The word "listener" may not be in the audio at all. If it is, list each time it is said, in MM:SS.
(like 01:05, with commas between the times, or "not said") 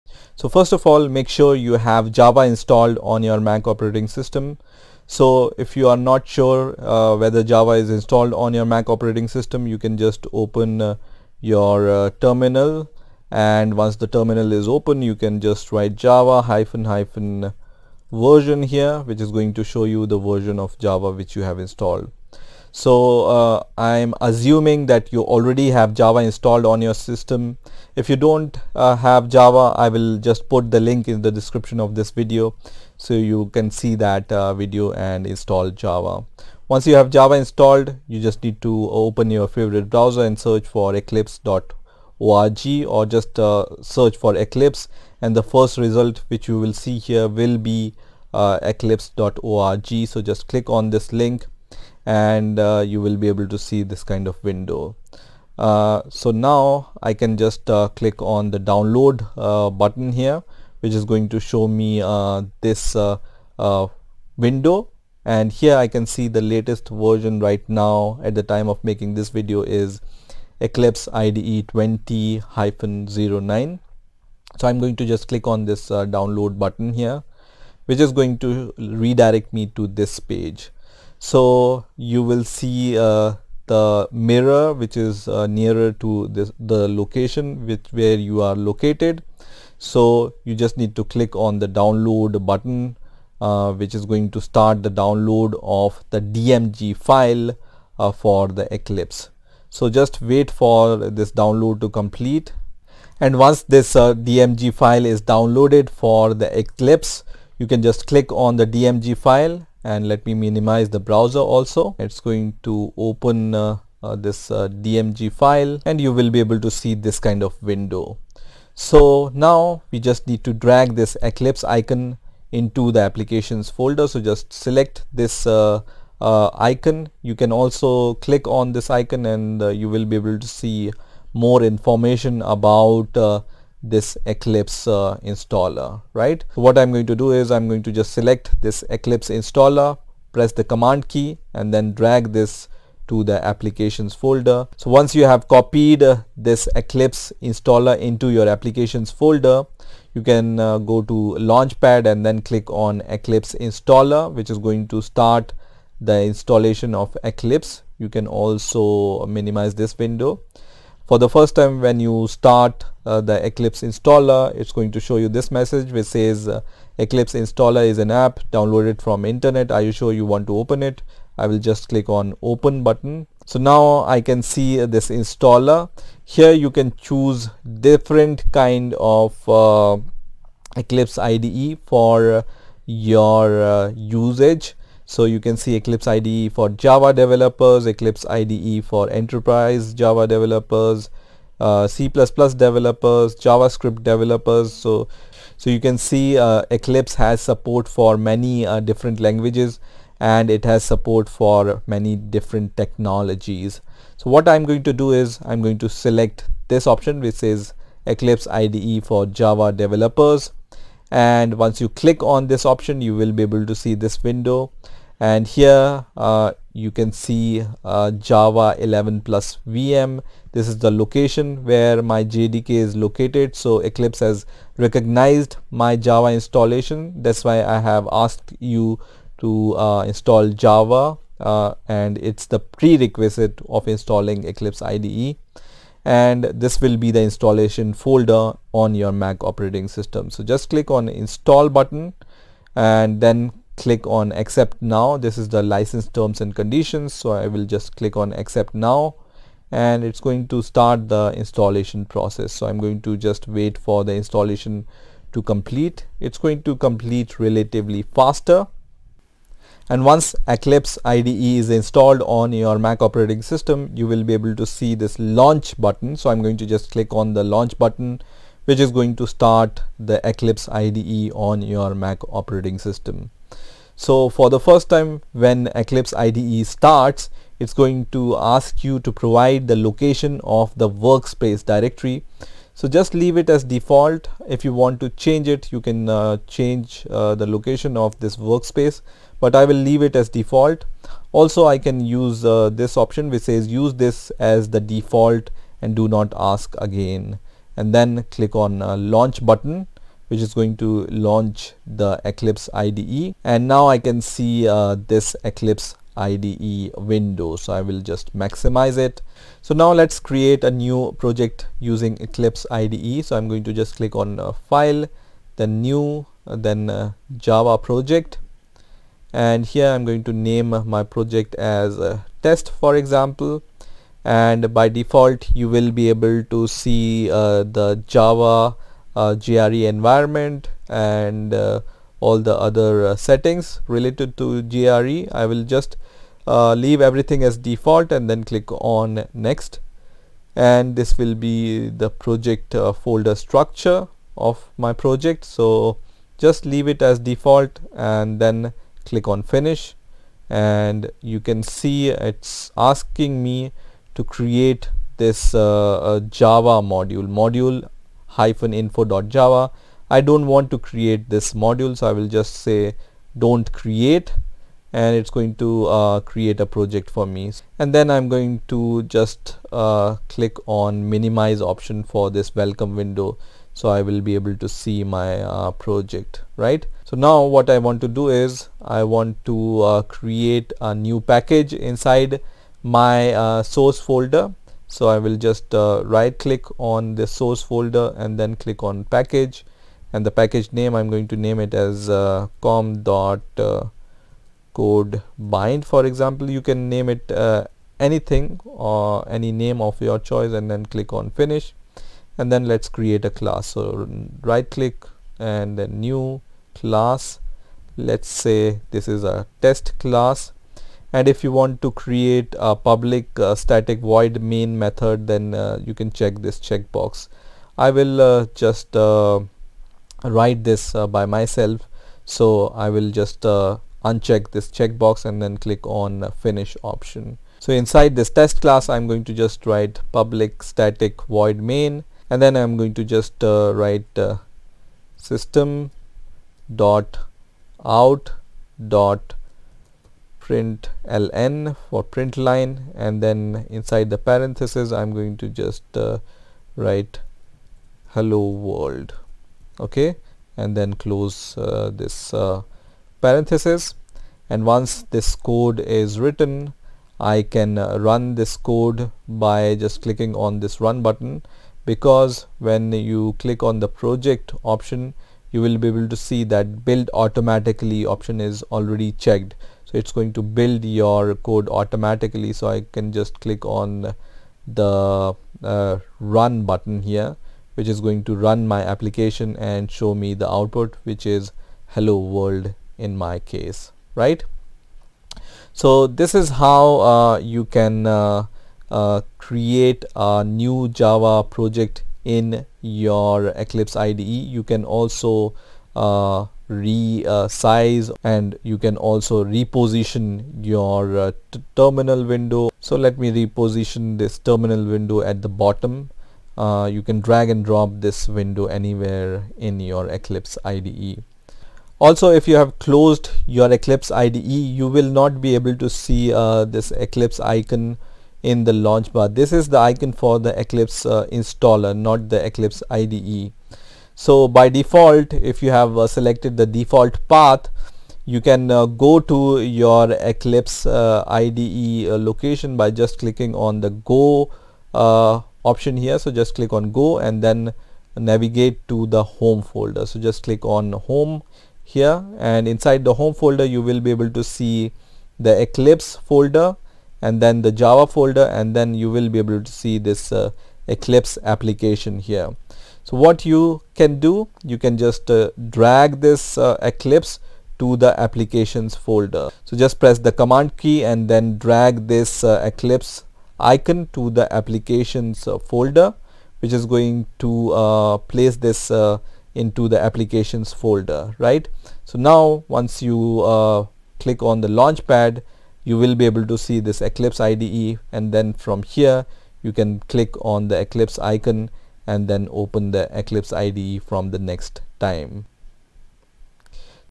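not said.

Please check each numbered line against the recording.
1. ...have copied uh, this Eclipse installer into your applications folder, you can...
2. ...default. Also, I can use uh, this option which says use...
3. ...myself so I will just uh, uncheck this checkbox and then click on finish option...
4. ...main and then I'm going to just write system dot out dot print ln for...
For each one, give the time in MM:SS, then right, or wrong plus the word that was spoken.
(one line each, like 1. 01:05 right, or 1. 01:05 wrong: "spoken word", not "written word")
1. 02:25 right
2. 04:50 right
3. 07:01 right
4. 07:11 right.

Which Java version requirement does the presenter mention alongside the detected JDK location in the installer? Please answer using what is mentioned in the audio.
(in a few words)
Java 11+ VM.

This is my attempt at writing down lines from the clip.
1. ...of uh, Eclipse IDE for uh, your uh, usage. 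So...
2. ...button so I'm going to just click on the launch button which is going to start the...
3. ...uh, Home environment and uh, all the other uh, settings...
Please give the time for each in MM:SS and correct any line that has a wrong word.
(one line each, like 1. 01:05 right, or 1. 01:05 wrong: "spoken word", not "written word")
1. 02:58 right
2. 04:25 right
3. 05:29 wrong: "JRE", not "Home".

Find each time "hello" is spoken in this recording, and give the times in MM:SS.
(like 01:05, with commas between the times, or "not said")
07:28, 08:01.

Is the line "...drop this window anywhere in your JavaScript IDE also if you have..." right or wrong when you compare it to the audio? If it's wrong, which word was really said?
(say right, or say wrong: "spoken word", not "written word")
wrong: "Eclipse", not "JavaScript".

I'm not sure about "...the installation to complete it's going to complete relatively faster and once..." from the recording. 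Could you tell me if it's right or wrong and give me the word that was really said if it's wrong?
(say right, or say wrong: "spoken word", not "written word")
right.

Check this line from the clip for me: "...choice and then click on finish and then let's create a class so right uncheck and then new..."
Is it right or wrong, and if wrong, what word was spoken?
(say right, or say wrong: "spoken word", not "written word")
wrong: "click", not "uncheck".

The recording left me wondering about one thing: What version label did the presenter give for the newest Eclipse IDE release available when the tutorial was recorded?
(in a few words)
20-09.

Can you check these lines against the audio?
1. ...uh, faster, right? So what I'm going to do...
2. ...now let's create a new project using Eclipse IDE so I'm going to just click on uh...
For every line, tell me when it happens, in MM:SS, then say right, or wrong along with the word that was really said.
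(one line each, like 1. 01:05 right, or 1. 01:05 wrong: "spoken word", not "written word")
1. 02:14 wrong: "installer", not "faster"
2. 05:09 right.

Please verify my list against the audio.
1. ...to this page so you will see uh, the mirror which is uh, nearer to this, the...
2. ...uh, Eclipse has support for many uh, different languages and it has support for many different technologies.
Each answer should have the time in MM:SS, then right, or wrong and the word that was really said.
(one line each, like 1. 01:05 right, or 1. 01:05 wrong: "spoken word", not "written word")
1. 01:19 right
2. 03:16 right.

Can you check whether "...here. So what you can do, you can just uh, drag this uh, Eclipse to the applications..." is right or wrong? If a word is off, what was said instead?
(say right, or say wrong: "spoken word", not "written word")
right.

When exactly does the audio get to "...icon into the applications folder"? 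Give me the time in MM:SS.
02:01.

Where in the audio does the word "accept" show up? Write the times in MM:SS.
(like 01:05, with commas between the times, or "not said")
04:04, 04:08.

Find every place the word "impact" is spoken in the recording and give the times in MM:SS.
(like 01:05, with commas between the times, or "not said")
not said.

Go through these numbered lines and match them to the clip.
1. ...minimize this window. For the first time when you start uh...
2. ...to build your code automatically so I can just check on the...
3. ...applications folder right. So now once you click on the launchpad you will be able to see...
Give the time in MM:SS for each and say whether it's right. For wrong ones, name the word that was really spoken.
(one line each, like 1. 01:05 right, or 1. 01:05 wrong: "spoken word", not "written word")
1. 02:39 right
2. 07:50 wrong: "click", not "check"
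3. 09:29 right.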